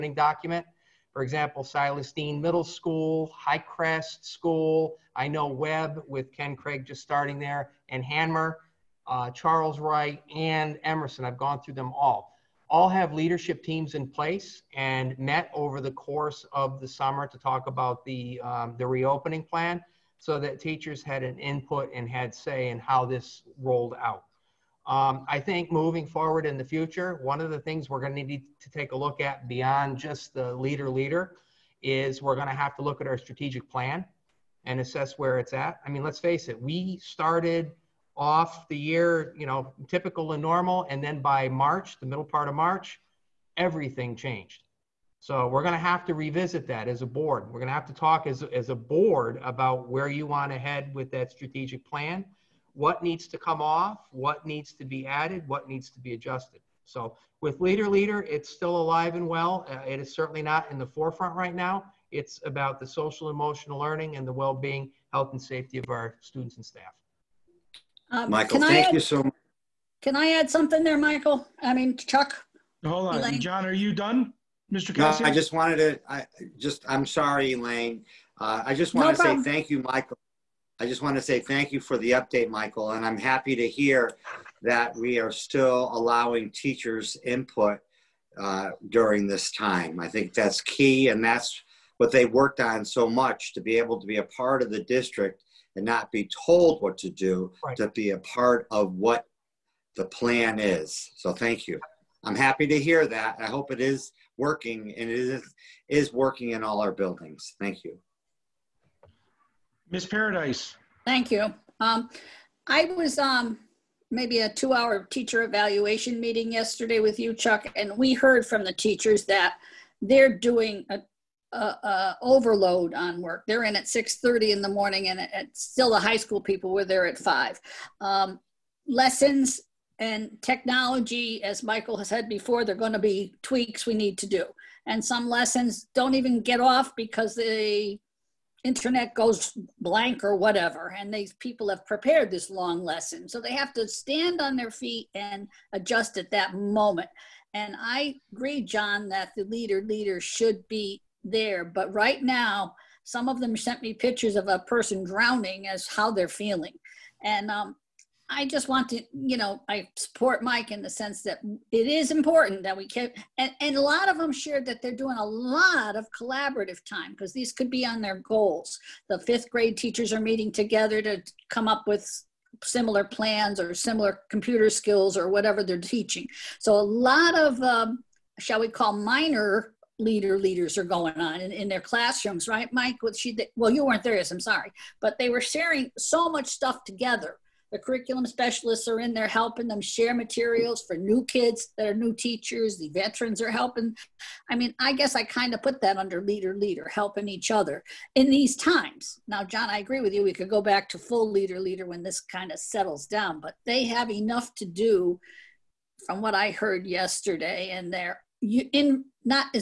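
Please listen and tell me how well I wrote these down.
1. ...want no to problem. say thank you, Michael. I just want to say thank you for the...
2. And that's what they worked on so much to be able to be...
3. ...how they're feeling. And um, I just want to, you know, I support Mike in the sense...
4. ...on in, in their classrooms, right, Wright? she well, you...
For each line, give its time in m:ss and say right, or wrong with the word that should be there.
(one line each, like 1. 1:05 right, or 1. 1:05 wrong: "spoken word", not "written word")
1. 1:18 right
2. 1:31 right
3. 2:35 right
4. 3:01 wrong: "Mike", not "Wright".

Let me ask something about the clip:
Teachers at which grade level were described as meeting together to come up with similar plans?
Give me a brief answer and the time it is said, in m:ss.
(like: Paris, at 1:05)
Fifth grade, at 2:49.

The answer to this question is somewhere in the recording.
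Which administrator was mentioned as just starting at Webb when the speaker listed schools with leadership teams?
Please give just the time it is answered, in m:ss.
0:06.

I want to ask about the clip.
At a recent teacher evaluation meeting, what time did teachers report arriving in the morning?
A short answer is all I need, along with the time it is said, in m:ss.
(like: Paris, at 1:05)
6:30, at 2:03.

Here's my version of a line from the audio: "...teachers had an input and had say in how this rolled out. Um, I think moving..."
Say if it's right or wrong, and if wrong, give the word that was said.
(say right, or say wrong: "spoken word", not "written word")
right.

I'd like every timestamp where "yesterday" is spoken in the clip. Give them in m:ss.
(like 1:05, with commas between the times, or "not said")
1:56, 3:26.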